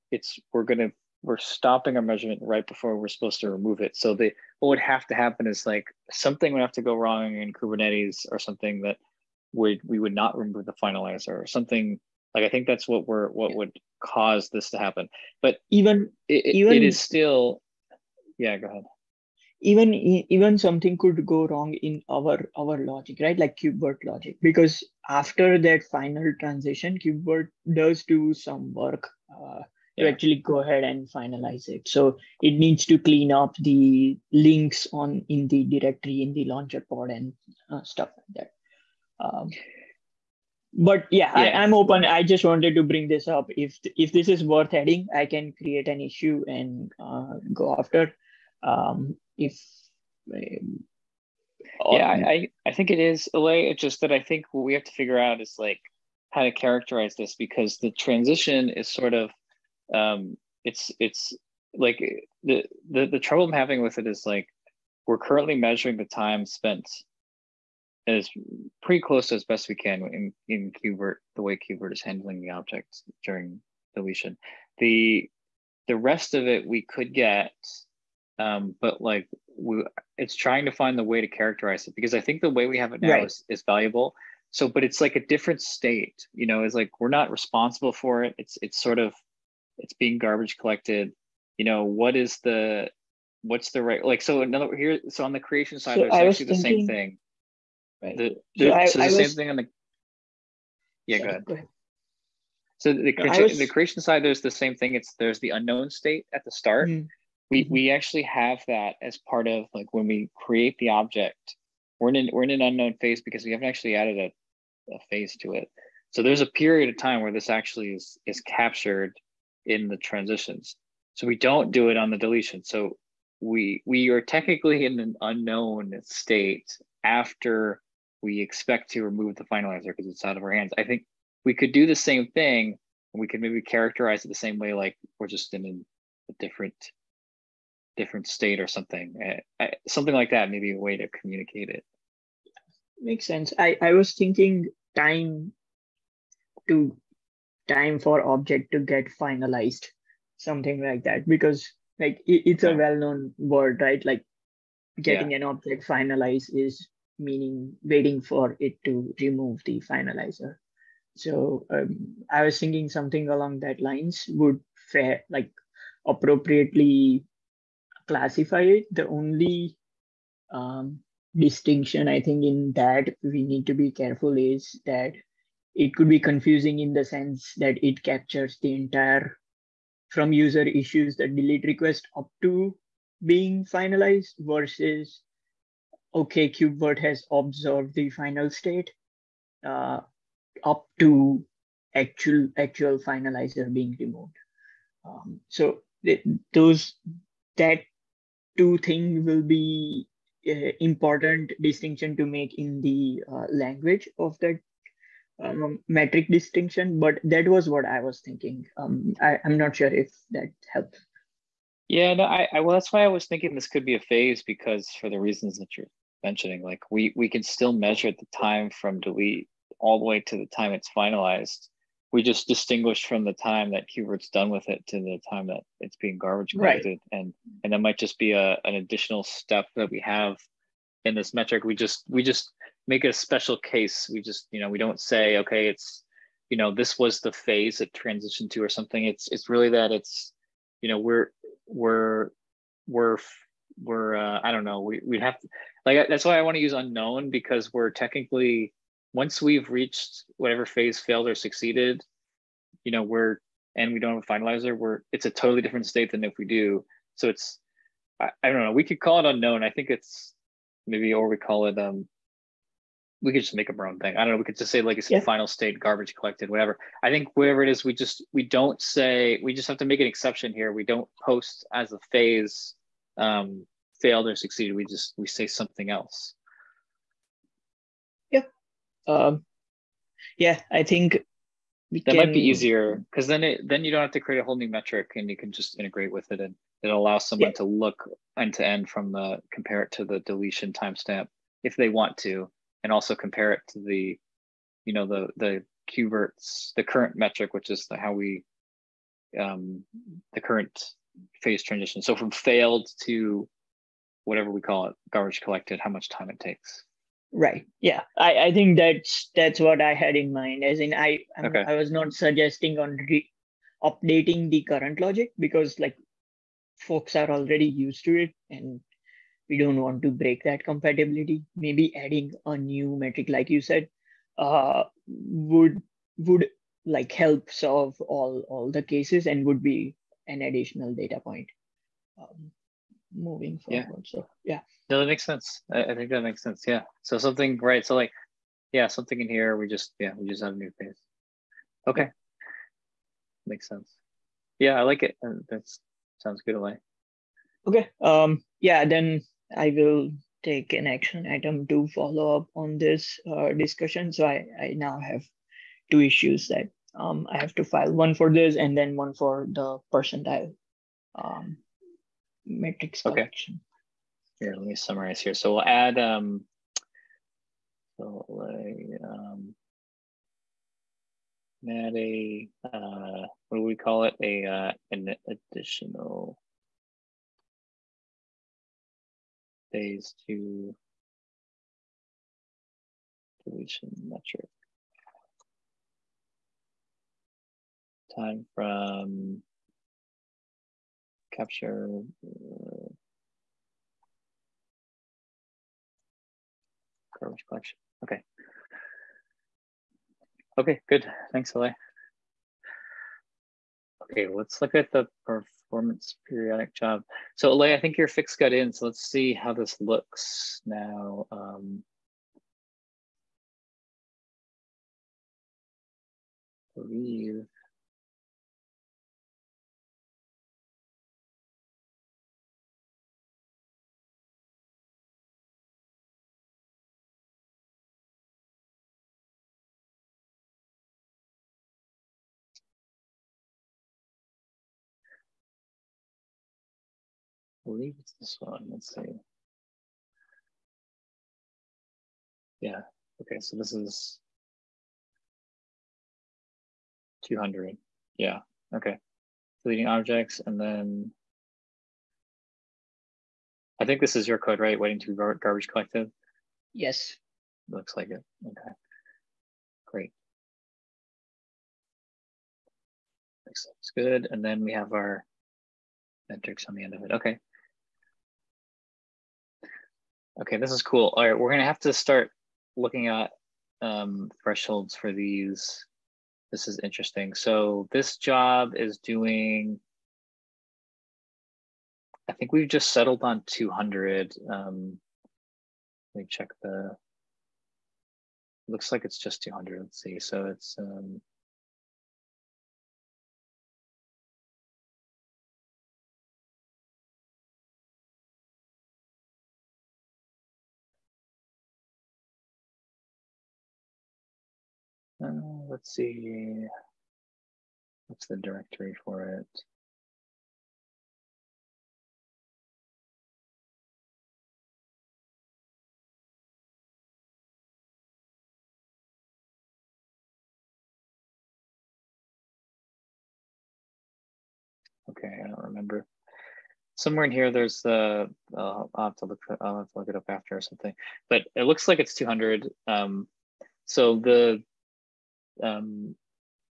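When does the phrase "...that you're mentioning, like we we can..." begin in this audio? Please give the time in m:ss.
3:35.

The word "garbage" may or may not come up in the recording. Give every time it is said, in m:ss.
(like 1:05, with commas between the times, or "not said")
1:30, 3:46, 4:25, 5:05, 6:37, 7:35.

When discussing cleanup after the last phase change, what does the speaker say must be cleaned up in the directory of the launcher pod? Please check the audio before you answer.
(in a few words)
the links.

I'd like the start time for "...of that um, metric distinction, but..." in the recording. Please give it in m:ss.
3:24.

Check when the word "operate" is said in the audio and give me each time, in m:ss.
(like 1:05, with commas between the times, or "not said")
not said.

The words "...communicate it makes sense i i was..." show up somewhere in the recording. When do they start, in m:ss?
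2:21.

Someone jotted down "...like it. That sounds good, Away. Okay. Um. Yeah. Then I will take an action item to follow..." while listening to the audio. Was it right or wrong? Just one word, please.
right.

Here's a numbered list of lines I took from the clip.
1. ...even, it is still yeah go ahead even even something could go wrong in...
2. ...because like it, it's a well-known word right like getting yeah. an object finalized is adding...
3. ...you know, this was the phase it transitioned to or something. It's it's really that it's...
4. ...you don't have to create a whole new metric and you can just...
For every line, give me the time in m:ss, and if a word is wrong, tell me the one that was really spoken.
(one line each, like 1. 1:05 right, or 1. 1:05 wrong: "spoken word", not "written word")
1. 0:16 right
2. 2:31 wrong: "meaning", not "adding"
3. 3:56 right
4. 4:43 right.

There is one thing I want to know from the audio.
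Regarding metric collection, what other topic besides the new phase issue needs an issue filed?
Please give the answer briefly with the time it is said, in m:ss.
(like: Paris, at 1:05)
percentile, at 5:59.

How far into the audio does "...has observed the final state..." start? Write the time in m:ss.
3:06.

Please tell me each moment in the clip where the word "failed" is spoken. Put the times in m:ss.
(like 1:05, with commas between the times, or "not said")
4:10, 4:34, 5:02.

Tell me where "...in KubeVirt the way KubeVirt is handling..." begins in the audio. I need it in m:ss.
1:10.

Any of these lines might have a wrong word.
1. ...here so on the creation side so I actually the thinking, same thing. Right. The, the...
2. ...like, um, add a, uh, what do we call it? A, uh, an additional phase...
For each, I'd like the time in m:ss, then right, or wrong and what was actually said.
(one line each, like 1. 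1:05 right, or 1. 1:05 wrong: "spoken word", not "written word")
1. 1:34 right
2. 6:08 right.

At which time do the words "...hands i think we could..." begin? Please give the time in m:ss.
2:10.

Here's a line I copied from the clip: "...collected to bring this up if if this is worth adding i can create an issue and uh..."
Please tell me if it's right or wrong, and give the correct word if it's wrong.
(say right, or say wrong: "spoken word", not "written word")
wrong: "wanted", not "collected".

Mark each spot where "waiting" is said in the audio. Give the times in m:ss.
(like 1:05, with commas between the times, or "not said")
2:37, 7:34.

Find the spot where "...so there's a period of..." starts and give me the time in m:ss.
1:56.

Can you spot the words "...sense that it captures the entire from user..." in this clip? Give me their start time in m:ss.
2:57.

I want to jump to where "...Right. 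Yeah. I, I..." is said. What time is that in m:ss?
5:07.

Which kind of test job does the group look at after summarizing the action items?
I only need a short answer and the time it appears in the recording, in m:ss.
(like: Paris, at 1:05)
performance periodic job, at 6:45.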